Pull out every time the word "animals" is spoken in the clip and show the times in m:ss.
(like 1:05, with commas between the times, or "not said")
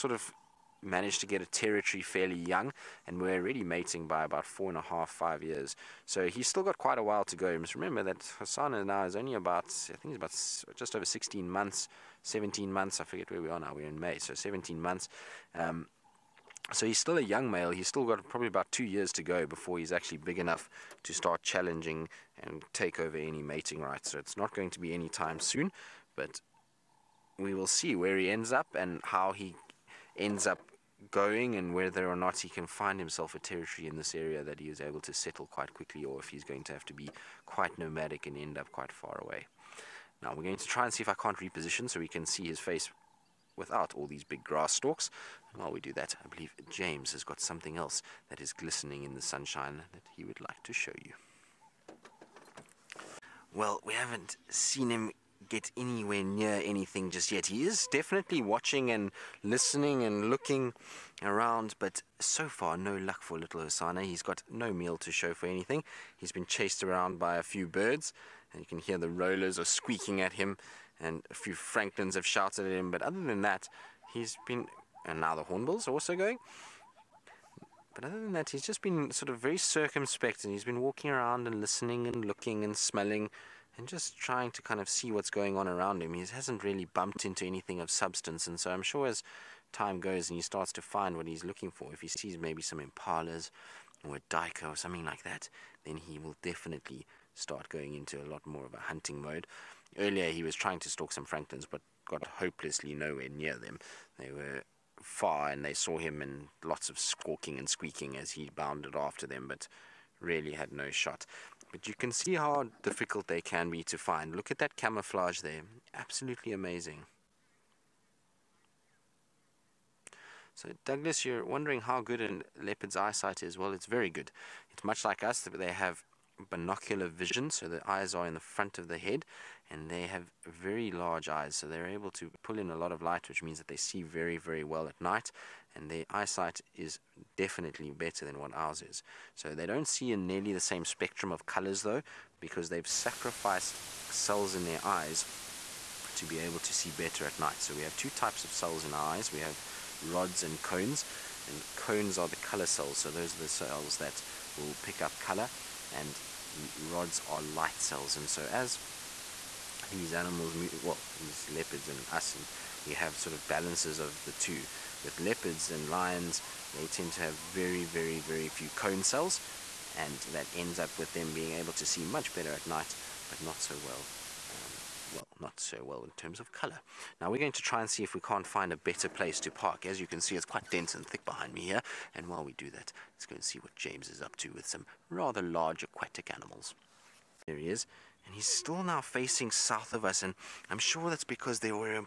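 2:40, 3:06.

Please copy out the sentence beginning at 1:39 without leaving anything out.
Earlier, he was trying to stalk some francolins, but got hopelessly nowhere near them.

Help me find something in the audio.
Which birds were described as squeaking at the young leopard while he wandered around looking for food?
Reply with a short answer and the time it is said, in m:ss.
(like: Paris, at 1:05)
Rollers, at 1:09.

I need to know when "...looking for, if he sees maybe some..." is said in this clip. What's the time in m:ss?
1:31.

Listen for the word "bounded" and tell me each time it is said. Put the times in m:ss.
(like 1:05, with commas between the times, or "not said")
1:48.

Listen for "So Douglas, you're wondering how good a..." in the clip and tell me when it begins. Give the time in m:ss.
2:00.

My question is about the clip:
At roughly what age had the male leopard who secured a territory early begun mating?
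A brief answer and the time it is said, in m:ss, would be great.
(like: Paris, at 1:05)
4.5 to 5 years, at 0:04.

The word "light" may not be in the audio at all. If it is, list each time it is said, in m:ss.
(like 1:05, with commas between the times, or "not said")
2:13, 2:37.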